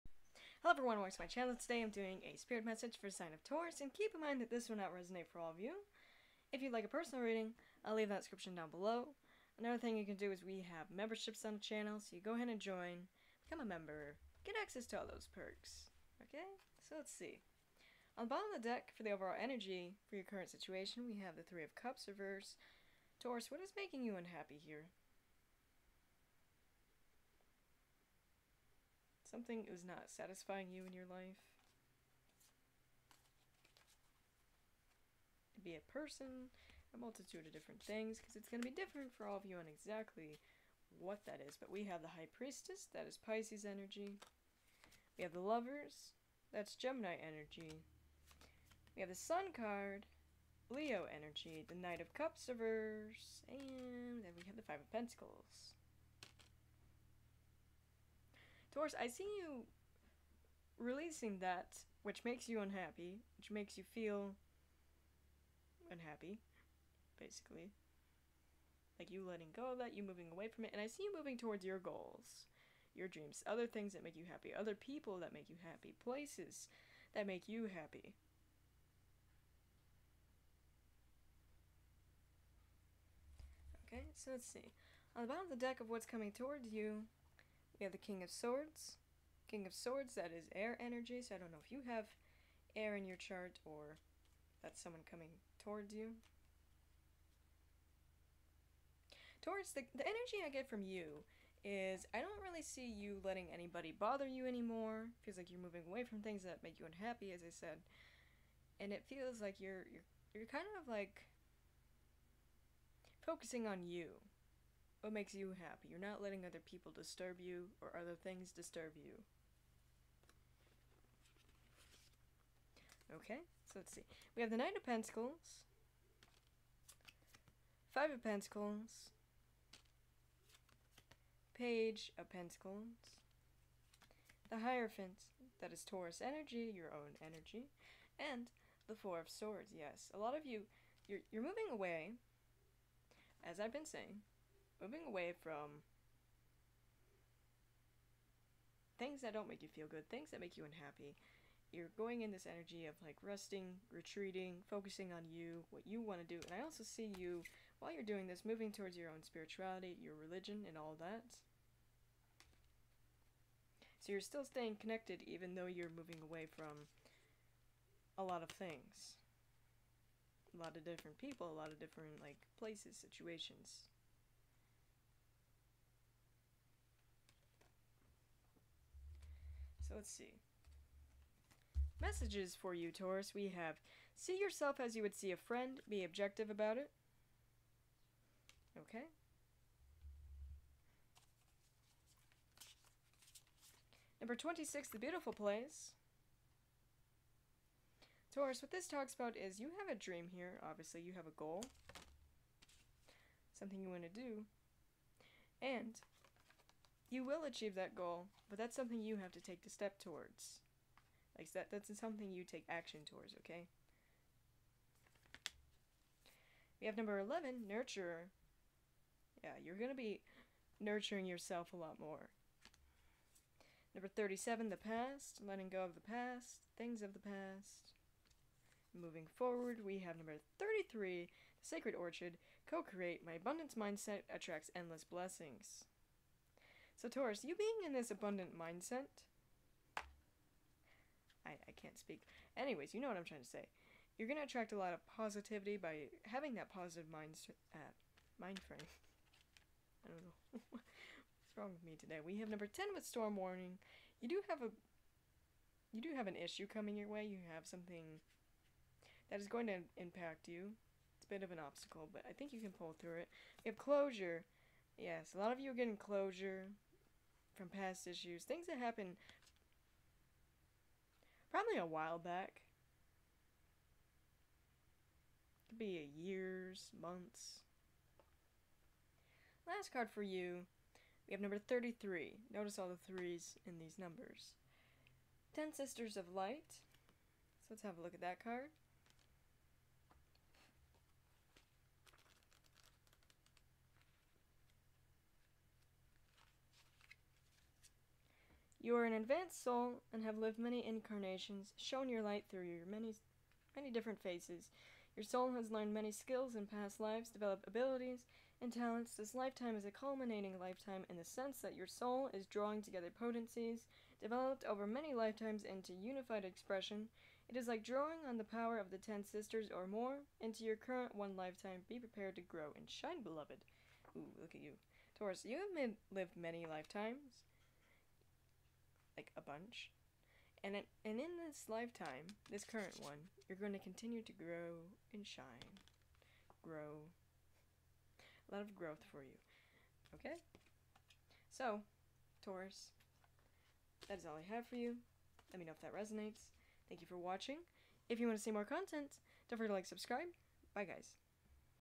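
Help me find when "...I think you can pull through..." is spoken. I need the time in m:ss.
4:22.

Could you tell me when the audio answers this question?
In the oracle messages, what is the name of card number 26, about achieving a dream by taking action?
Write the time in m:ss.
3:14.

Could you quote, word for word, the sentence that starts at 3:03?
We have see yourself as you would see a friend, be objective about it.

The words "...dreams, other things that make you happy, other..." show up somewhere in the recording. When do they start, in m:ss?
1:13.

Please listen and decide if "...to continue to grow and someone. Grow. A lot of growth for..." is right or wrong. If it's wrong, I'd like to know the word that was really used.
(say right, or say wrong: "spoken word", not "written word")
wrong: "shine", not "someone".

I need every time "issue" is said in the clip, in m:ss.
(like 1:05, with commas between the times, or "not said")
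4:16, 4:28.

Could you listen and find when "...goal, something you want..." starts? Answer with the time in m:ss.
3:21.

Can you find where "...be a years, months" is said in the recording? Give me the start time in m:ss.
4:35.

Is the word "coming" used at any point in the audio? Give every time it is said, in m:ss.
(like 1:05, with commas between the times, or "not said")
1:26, 1:35, 4:16.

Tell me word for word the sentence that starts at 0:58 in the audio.
Taurus, I see you releasing that which makes you unhappy, which makes you feel unhappy, basically.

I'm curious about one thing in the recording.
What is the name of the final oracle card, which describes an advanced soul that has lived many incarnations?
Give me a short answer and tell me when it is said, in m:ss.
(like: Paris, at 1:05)
Ten Sisters of Light, at 4:45.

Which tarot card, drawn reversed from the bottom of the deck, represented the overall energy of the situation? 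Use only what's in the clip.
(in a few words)
Three of Cups.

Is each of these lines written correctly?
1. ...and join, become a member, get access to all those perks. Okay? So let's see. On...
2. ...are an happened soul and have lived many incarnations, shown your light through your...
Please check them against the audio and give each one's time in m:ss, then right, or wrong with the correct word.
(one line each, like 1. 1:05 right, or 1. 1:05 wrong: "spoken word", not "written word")
1. 0:12 right
2. 4:58 wrong: "advanced", not "happened".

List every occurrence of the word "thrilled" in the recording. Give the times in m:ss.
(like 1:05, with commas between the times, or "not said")
not said.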